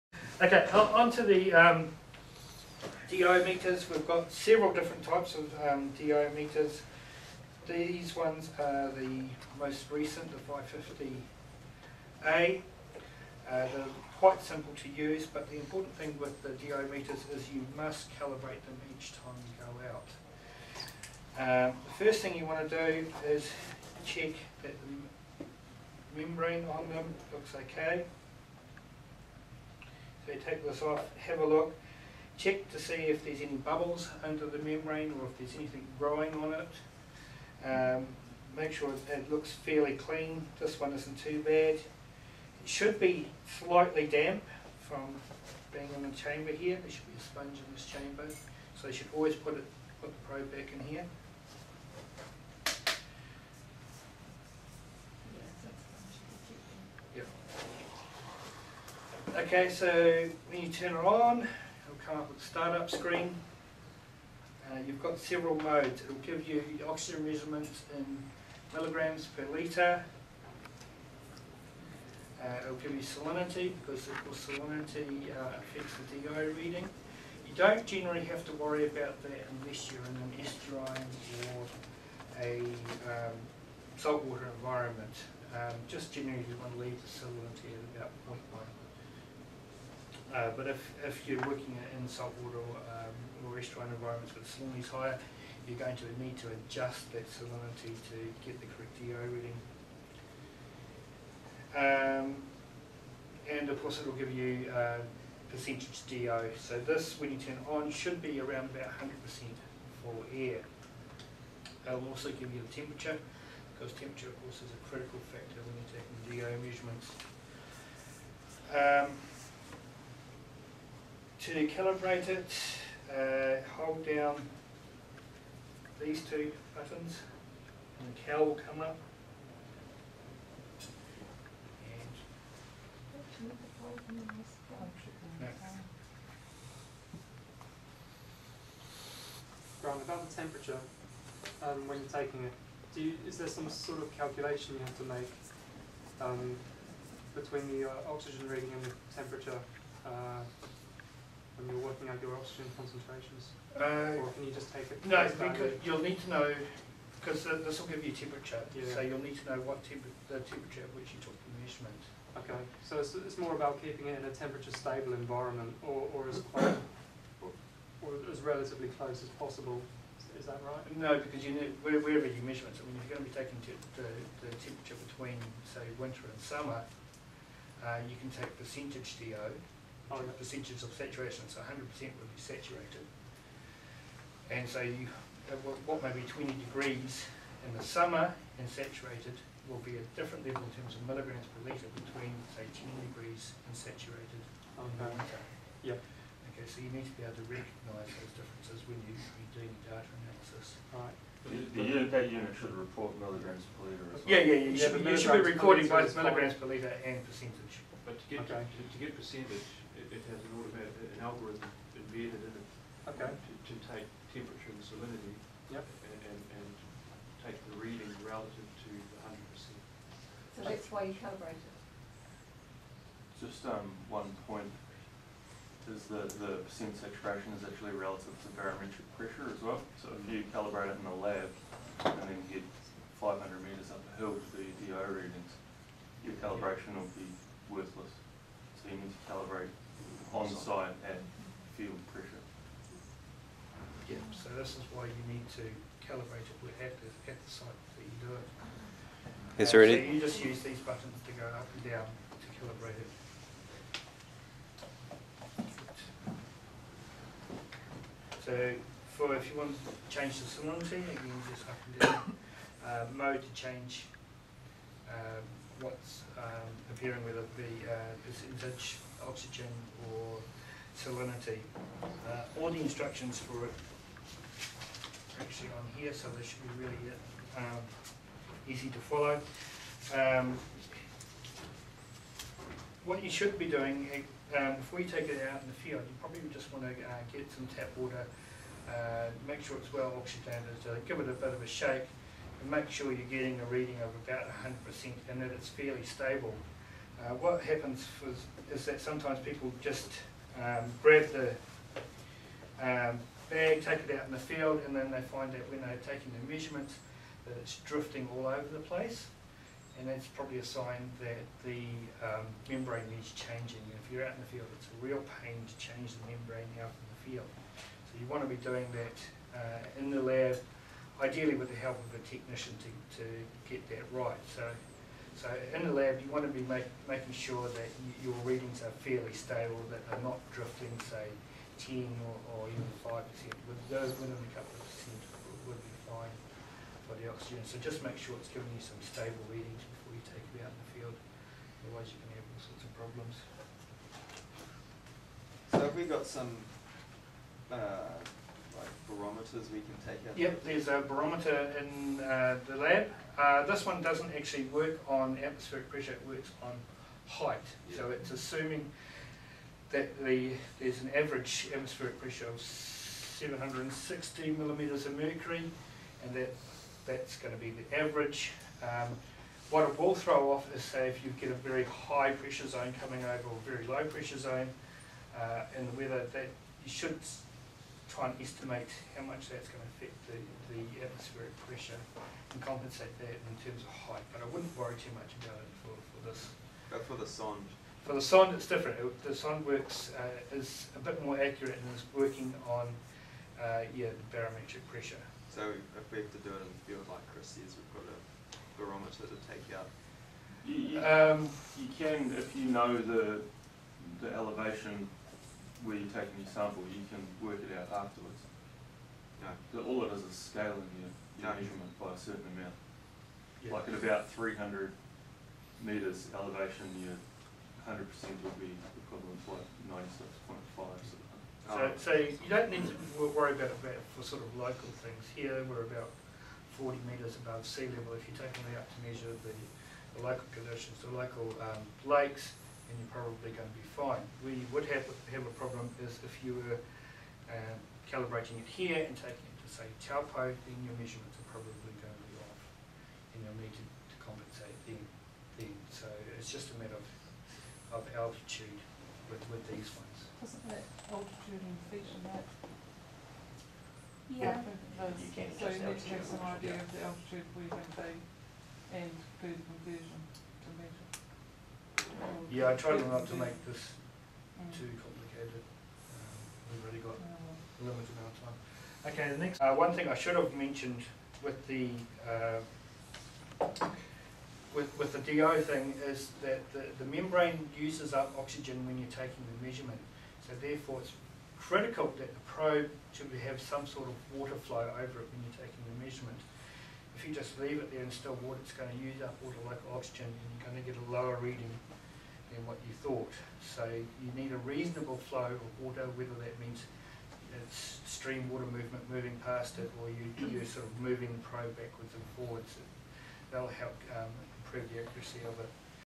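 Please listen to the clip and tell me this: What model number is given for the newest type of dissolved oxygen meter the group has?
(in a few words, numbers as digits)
550A.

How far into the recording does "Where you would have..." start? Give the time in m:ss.
7:14.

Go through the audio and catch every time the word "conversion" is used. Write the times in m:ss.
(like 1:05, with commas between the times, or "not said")
7:39.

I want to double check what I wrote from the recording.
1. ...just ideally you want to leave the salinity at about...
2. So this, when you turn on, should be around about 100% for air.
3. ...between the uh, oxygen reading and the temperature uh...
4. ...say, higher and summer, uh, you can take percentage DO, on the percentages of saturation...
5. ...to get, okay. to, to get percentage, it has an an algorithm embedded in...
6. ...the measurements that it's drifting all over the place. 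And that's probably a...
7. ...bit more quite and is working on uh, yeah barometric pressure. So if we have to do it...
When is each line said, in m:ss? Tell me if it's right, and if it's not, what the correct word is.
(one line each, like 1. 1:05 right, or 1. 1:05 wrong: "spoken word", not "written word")
1. 1:25 wrong: "generally", not "ideally"
2. 1:46 right
3. 2:27 right
4. 2:55 wrong: "winter", not "higher"
5. 3:28 right
6. 5:06 right
7. 6:30 wrong: "accurate", not "quite".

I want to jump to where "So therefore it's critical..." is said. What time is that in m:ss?
8:00.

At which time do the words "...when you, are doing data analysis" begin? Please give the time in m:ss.
3:18.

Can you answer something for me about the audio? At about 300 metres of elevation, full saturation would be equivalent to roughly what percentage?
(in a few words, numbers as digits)
96.5.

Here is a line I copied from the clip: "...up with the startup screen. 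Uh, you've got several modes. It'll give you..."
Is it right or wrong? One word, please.
right.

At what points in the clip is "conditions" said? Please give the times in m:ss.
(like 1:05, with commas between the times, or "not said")
7:10.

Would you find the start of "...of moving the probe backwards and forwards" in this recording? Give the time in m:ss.
8:20.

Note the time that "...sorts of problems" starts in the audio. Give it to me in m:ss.
5:42.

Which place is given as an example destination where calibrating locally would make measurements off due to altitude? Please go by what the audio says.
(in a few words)
Taupo.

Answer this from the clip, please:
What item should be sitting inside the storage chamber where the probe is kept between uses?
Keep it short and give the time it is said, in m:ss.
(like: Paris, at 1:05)
a sponge, at 0:47.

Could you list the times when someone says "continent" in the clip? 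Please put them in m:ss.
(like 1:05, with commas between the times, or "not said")
not said.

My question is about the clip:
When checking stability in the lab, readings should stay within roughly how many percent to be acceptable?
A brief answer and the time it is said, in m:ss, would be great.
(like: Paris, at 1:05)
a couple of percent, at 5:34.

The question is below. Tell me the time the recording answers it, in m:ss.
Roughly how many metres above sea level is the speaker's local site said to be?
7:06.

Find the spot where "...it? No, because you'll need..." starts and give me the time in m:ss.
2:34.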